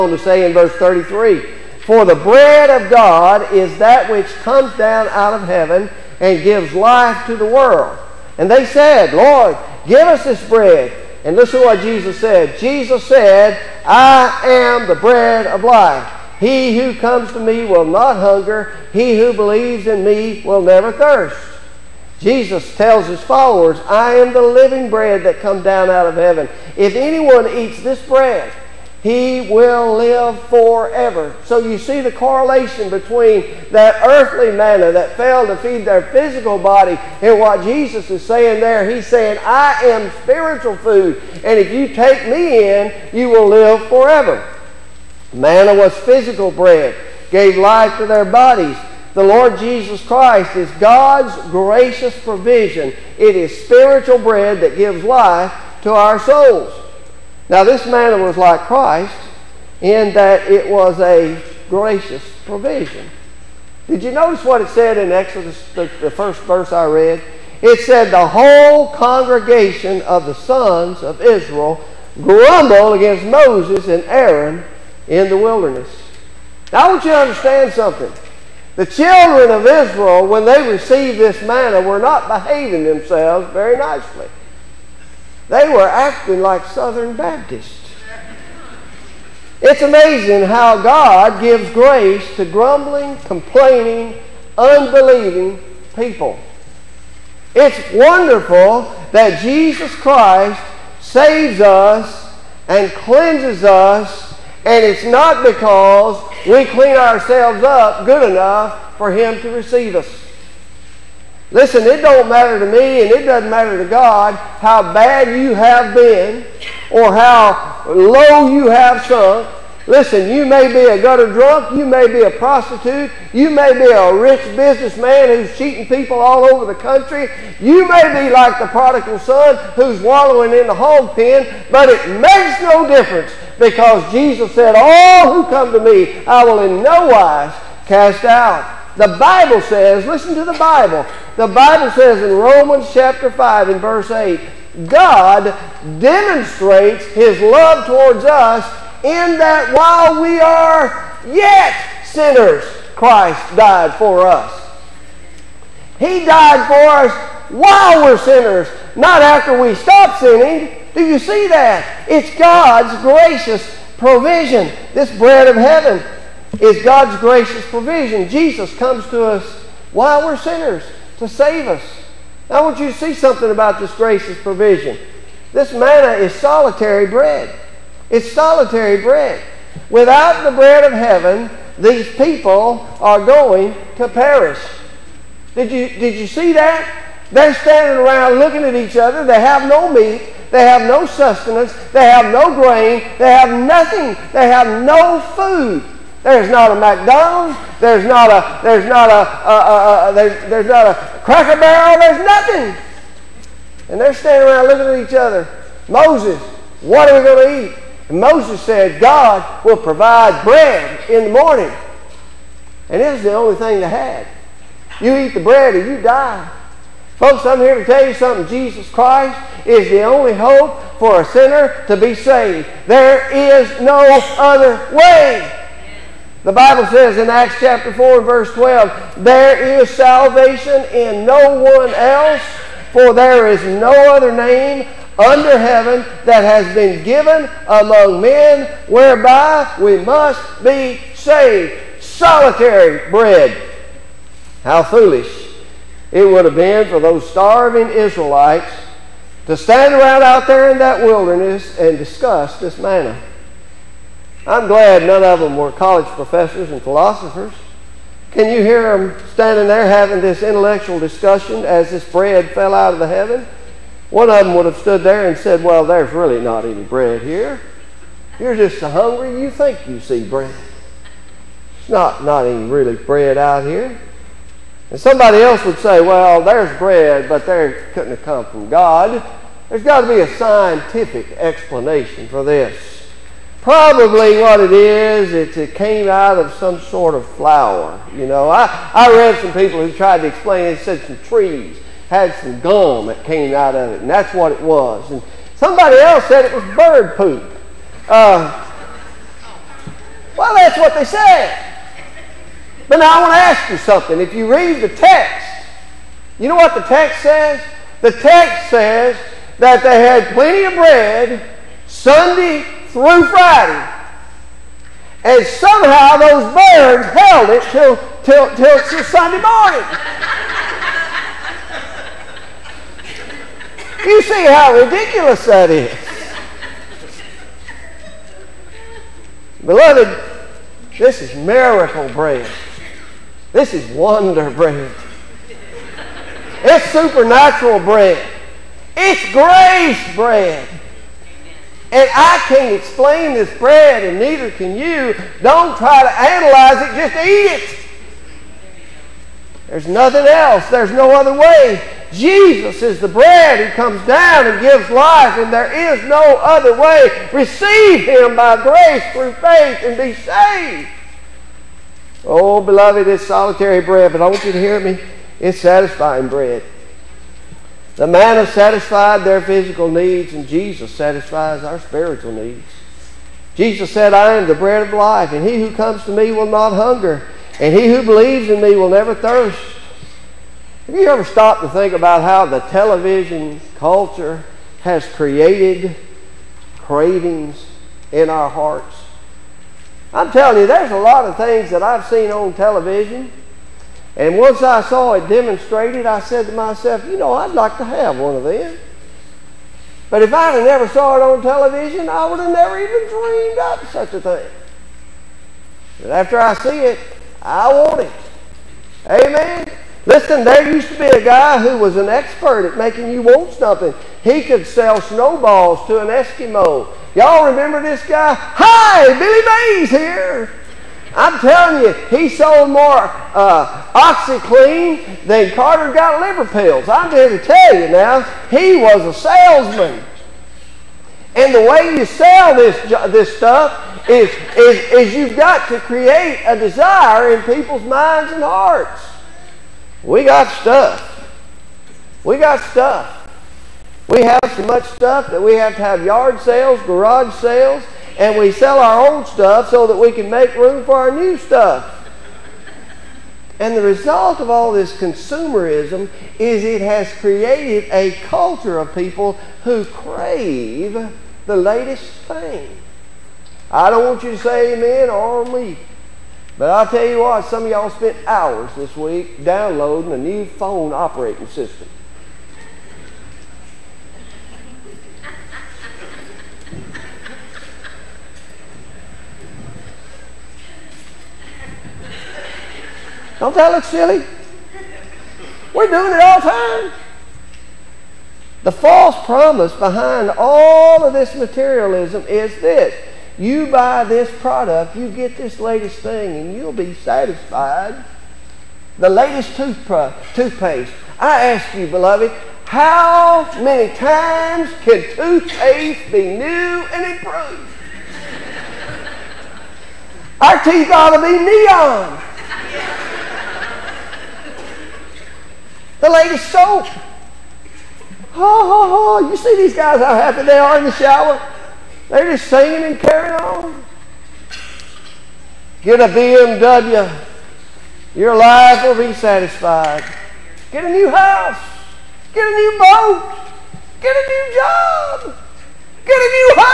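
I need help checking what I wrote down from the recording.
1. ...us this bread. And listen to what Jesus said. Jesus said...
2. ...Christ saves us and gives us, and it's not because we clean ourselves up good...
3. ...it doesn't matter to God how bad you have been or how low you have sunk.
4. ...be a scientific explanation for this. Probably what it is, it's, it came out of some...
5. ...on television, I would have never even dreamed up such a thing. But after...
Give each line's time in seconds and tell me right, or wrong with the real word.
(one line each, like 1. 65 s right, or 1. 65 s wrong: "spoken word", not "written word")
1. 10 s right
2. 99 s wrong: "cleanses", not "gives"
3. 113 s right
4. 280 s right
5. 401 s right.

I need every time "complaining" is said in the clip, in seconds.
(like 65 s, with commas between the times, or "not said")
93 s.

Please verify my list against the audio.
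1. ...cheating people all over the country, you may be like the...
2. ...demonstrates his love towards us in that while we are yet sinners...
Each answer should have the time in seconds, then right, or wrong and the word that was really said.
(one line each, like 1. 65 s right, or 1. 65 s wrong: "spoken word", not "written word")
1. 125 s right
2. 145 s right.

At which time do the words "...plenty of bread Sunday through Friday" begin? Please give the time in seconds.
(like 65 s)
310 s.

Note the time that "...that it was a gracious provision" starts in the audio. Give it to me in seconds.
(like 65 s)
60 s.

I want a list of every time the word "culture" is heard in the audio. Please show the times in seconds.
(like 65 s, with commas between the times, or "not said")
383 s, 458 s.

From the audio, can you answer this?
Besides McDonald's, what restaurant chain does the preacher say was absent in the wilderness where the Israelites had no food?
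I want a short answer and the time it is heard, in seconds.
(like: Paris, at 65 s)
Cracker Barrel, at 201 s.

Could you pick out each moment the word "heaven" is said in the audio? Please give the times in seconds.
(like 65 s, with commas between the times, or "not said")
5 s, 26 s, 165 s, 180 s, 235 s, 263 s.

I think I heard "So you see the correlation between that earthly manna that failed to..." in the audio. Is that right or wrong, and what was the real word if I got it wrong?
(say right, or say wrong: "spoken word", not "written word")
right.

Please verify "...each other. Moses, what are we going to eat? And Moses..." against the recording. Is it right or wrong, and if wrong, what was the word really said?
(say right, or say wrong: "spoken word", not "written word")
right.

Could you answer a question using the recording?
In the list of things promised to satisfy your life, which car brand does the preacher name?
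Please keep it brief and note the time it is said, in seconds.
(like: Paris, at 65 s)
BMW, at 526 s.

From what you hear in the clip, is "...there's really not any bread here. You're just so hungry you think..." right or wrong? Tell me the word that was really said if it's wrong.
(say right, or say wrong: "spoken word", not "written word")
right.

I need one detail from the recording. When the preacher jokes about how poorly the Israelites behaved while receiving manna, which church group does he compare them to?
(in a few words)
Southern Baptists.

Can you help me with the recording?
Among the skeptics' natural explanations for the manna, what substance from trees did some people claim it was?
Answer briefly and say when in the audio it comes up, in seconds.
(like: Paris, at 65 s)
Gum, at 292 s.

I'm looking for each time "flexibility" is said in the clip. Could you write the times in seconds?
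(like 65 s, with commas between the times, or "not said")
not said.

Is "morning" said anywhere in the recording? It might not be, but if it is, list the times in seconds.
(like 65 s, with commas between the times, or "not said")
211 s, 319 s.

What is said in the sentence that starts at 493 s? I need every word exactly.
You buy this product, you get this latest thing, and you'll be satisfied.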